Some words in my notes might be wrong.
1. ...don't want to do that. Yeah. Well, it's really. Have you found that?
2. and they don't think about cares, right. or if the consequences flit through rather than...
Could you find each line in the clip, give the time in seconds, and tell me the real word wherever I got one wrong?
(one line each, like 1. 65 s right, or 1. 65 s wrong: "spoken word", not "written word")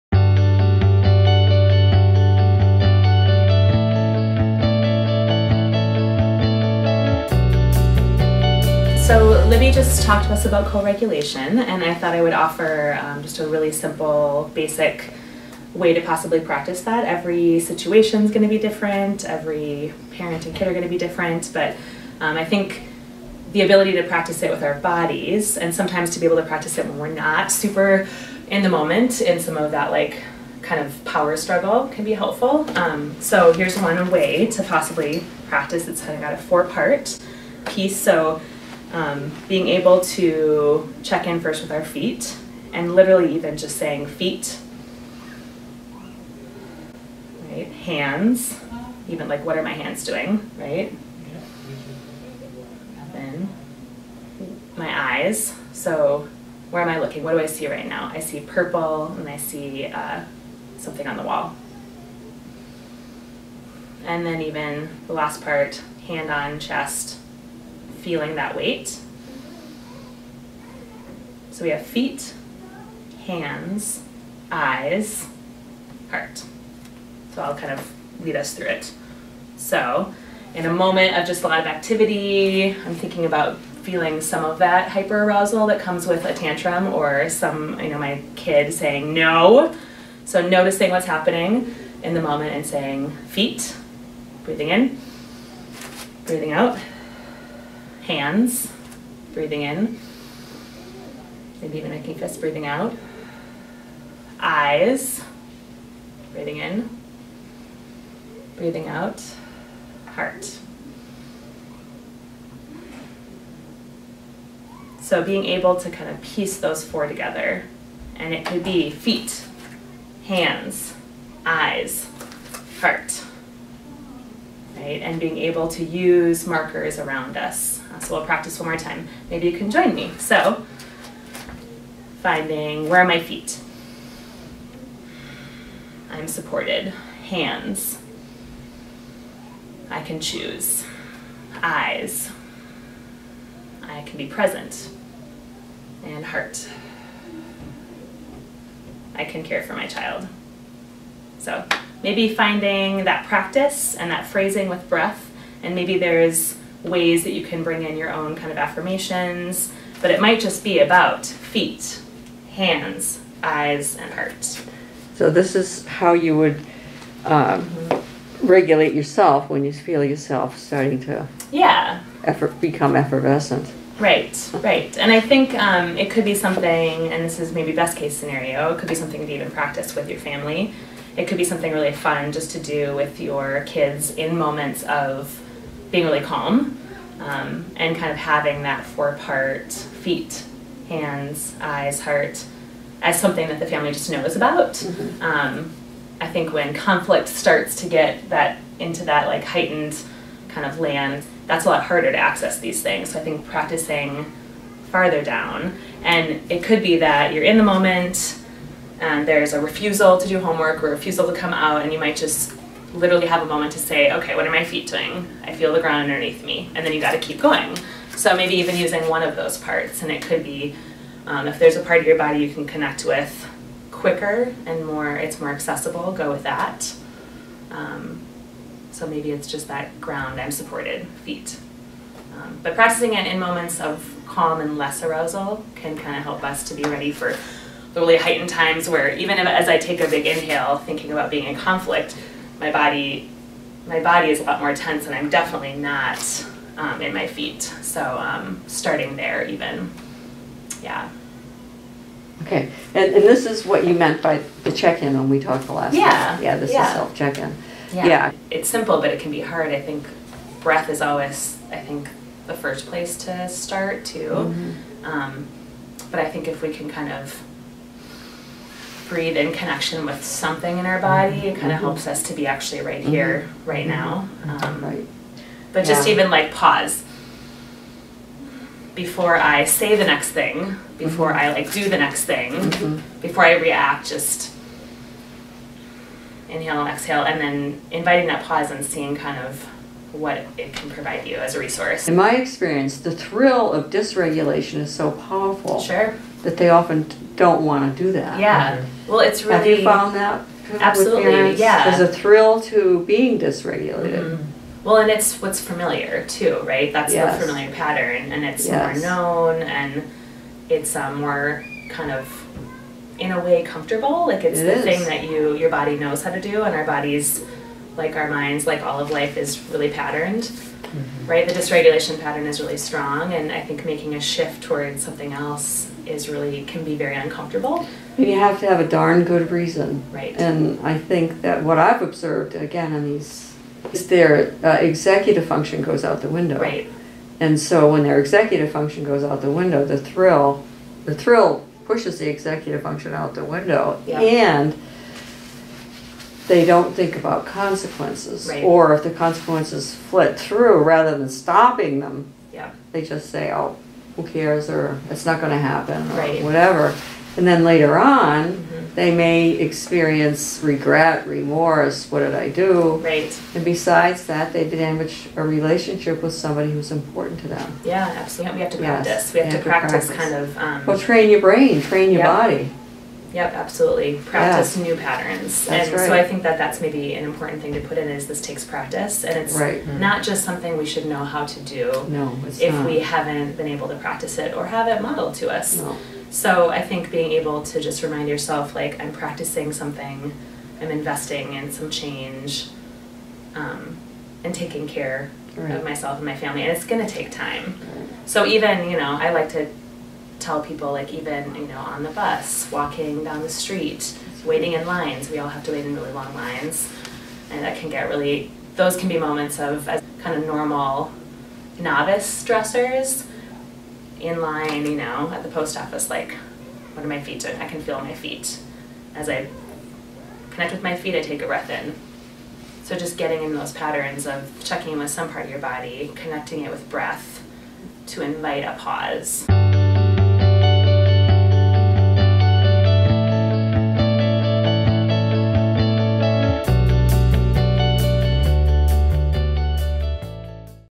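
1. 297 s right
2. 344 s wrong: "consequences", not "cares".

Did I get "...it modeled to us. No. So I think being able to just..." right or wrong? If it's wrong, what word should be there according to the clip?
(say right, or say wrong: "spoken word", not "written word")
right.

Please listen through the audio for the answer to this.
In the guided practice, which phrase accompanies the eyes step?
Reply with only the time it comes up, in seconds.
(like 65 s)
143 s.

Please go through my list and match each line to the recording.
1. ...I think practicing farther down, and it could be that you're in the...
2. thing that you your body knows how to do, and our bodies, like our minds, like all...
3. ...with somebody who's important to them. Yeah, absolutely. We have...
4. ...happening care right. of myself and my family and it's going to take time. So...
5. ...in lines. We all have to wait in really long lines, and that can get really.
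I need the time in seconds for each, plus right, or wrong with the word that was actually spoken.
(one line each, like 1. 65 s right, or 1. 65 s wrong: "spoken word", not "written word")
1. 203 s right
2. 314 s right
3. 366 s right
4. 394 s wrong: "taking", not "happening"
5. 404 s right.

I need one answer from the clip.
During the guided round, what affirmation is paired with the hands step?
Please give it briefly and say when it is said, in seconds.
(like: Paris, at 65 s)
I can choose, at 139 s.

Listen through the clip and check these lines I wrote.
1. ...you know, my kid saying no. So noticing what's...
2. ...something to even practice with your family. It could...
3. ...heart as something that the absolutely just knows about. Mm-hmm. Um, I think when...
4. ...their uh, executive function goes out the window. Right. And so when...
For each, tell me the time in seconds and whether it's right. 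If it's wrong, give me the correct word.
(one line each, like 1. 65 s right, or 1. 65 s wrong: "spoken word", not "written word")
1. 87 s right
2. 178 s right
3. 192 s wrong: "family", not "absolutely"
4. 334 s right.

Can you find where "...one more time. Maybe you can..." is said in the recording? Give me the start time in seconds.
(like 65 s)
128 s.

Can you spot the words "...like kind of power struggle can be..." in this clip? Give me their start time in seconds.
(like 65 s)
29 s.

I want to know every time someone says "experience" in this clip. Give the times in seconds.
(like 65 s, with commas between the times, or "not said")
292 s, 359 s.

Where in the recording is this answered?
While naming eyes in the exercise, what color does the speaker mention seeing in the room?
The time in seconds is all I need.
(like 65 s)
58 s.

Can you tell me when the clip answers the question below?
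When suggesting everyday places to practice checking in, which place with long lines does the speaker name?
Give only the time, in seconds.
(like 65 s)
415 s.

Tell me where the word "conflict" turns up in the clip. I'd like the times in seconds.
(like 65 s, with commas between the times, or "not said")
196 s, 241 s.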